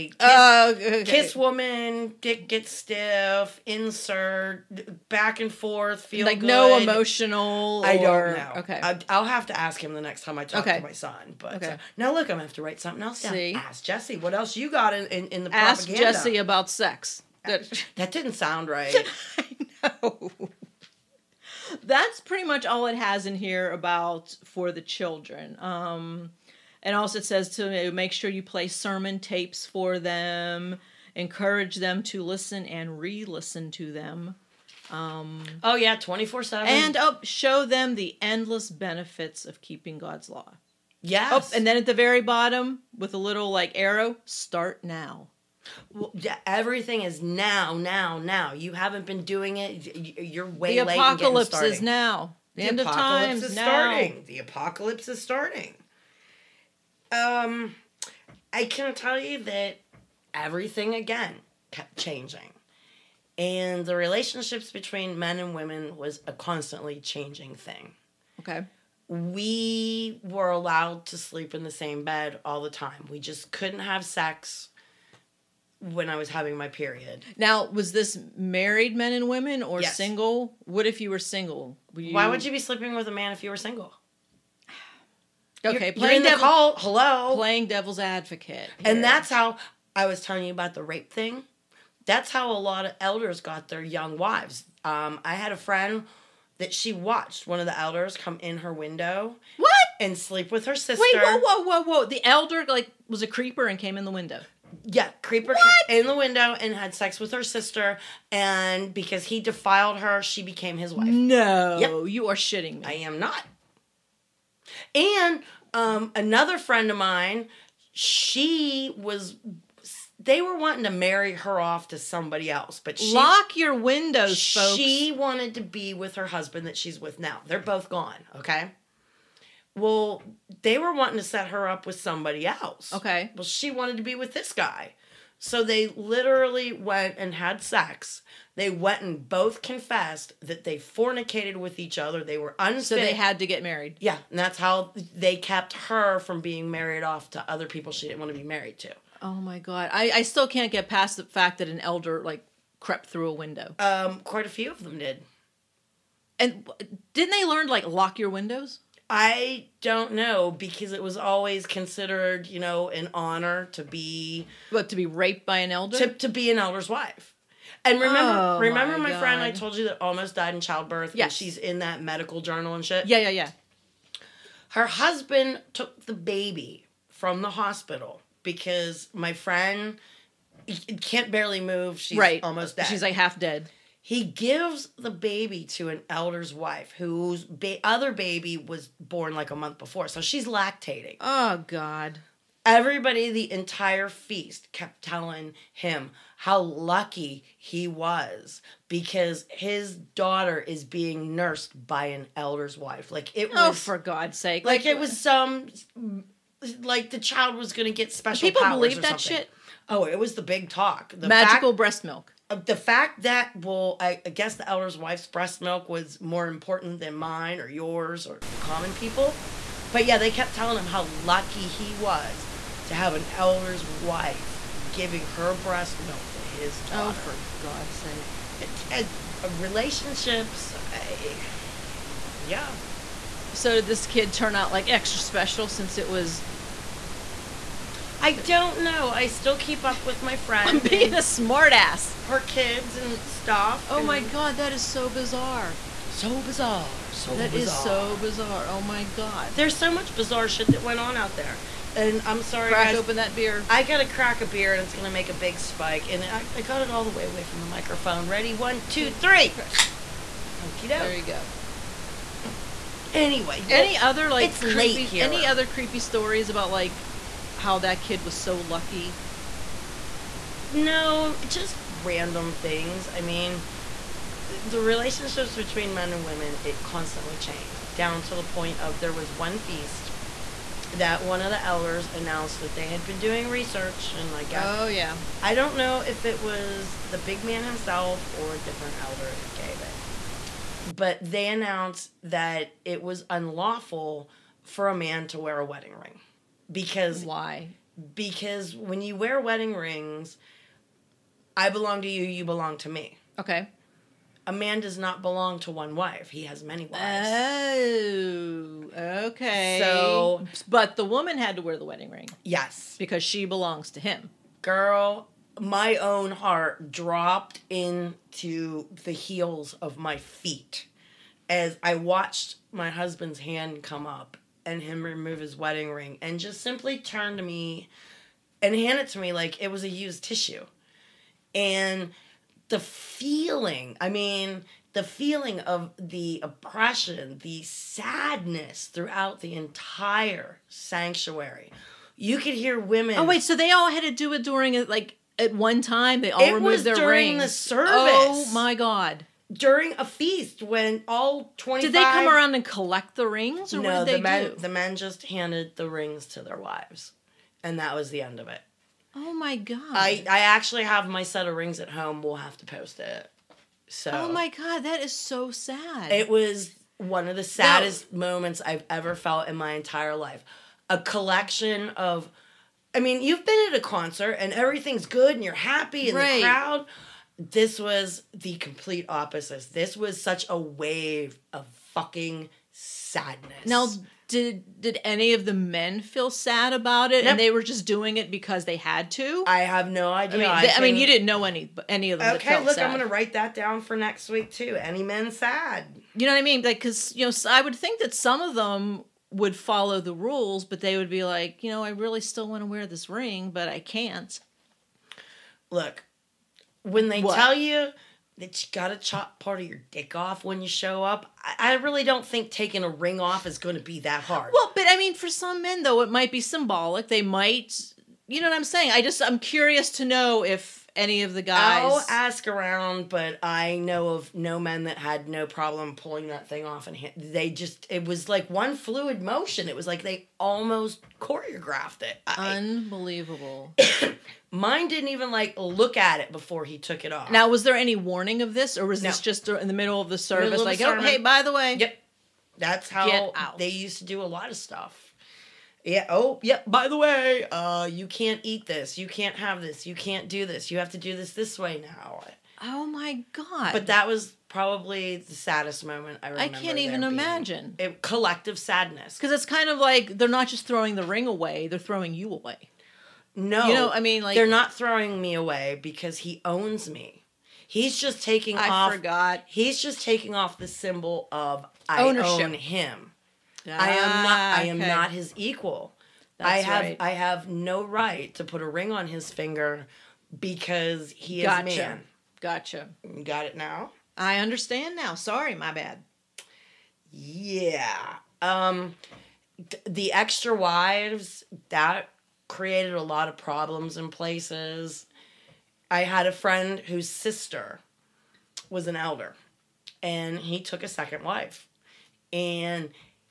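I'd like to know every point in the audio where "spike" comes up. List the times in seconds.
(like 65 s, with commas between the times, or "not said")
255 s.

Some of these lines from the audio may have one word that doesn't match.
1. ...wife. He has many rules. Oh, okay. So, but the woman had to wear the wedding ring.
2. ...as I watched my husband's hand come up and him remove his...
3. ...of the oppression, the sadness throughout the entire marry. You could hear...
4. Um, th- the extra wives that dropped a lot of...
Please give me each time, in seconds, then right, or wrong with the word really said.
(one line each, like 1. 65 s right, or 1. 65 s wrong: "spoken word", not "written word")
1. 305 s wrong: "wives", not "rules"
2. 321 s right
3. 335 s wrong: "sanctuary", not "marry"
4. 488 s wrong: "created", not "dropped".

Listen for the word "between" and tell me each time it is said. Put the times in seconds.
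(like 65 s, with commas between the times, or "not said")
64 s, 275 s.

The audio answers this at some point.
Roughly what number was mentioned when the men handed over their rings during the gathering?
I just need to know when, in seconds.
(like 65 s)
351 s.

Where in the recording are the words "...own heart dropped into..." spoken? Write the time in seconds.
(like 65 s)
315 s.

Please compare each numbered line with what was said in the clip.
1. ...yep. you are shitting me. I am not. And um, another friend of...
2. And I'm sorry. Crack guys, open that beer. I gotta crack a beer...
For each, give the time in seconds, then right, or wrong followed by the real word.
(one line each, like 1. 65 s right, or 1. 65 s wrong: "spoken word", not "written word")
1. 111 s right
2. 251 s right.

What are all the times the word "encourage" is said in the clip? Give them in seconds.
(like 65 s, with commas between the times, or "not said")
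31 s.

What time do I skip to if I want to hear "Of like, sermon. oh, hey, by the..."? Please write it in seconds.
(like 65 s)
440 s.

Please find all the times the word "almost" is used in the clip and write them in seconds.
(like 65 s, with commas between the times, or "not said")
170 s, 182 s, 430 s.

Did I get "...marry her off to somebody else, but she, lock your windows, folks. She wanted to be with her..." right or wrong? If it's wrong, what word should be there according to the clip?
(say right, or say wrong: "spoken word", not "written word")
right.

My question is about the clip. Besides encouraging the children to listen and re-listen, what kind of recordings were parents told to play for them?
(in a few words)
sermon tapes.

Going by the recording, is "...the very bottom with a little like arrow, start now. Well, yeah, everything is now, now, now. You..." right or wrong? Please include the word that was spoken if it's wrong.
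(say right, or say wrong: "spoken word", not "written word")
right.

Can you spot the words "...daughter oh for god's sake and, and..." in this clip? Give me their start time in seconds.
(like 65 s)
226 s.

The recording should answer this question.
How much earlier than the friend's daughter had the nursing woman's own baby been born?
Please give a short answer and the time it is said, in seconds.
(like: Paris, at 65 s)
a month, at 189 s.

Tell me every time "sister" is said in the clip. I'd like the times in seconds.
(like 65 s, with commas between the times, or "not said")
100 s, 107 s, 497 s.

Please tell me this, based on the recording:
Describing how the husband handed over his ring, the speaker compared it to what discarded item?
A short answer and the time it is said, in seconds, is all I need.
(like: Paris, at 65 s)
used tissue, at 329 s.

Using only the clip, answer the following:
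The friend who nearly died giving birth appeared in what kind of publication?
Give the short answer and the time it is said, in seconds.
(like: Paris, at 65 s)
medical journal, at 172 s.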